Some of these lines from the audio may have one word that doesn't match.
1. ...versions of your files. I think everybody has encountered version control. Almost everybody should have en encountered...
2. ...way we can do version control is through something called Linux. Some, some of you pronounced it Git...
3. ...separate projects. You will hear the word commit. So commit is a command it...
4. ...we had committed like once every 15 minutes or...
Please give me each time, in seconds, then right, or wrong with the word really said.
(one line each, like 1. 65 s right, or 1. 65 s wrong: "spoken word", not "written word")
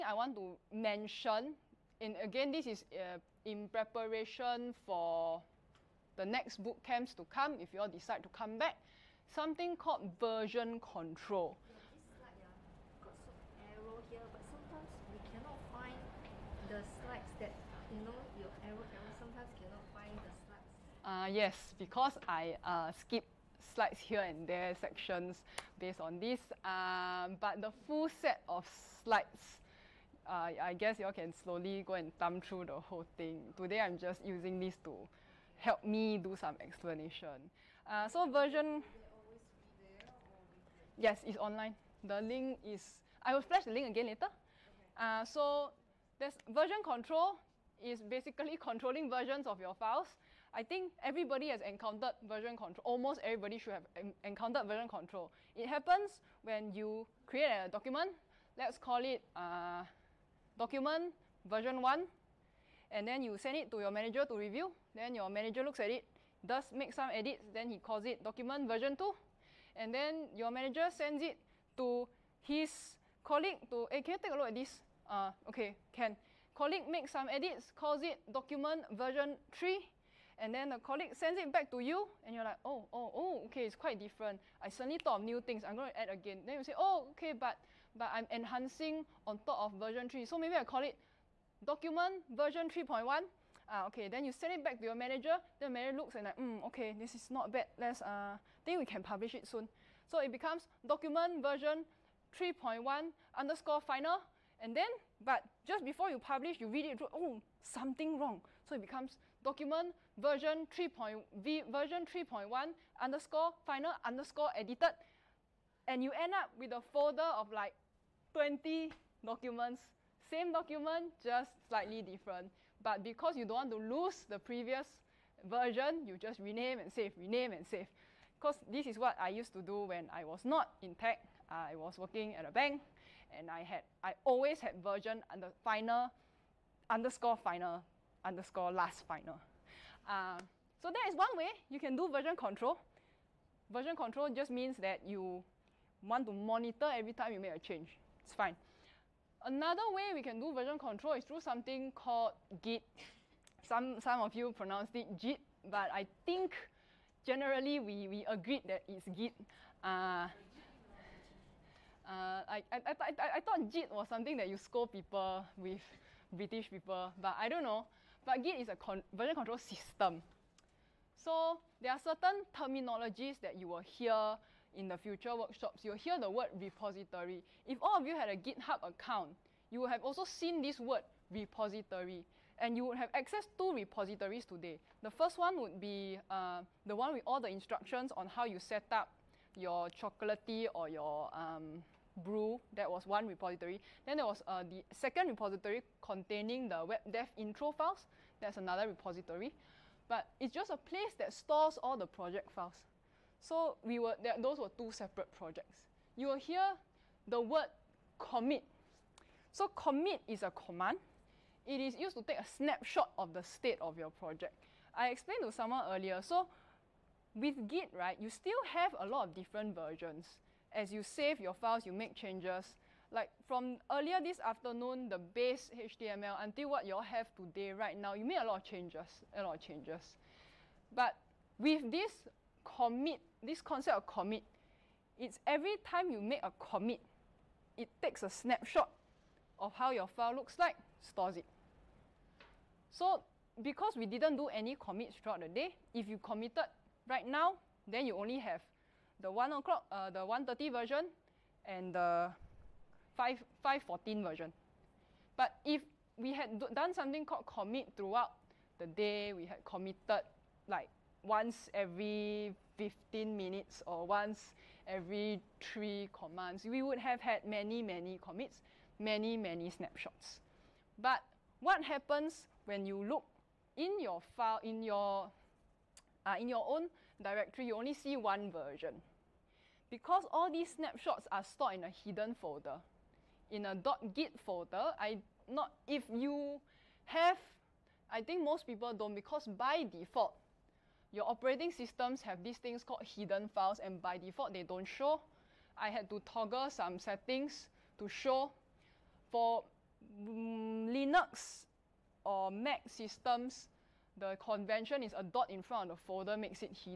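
1. 49 s right
2. 149 s wrong: "Git", not "Linux"
3. 204 s right
4. 259 s right.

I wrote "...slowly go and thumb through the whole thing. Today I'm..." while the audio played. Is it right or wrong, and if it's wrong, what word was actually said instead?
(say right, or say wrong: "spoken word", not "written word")
right.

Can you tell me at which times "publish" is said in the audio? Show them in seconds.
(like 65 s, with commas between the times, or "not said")
99 s, 106 s.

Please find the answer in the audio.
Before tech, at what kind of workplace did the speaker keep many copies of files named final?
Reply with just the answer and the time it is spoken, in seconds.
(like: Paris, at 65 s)
a bank, at 132 s.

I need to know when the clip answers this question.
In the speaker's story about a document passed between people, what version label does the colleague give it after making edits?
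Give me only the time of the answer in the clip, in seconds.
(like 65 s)
78 s.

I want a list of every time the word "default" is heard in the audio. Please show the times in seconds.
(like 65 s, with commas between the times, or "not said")
289 s, 294 s.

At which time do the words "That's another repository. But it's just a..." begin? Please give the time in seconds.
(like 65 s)
198 s.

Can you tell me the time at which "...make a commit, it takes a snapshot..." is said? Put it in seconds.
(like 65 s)
236 s.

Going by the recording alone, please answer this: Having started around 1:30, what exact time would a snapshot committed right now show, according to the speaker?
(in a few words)
5.14.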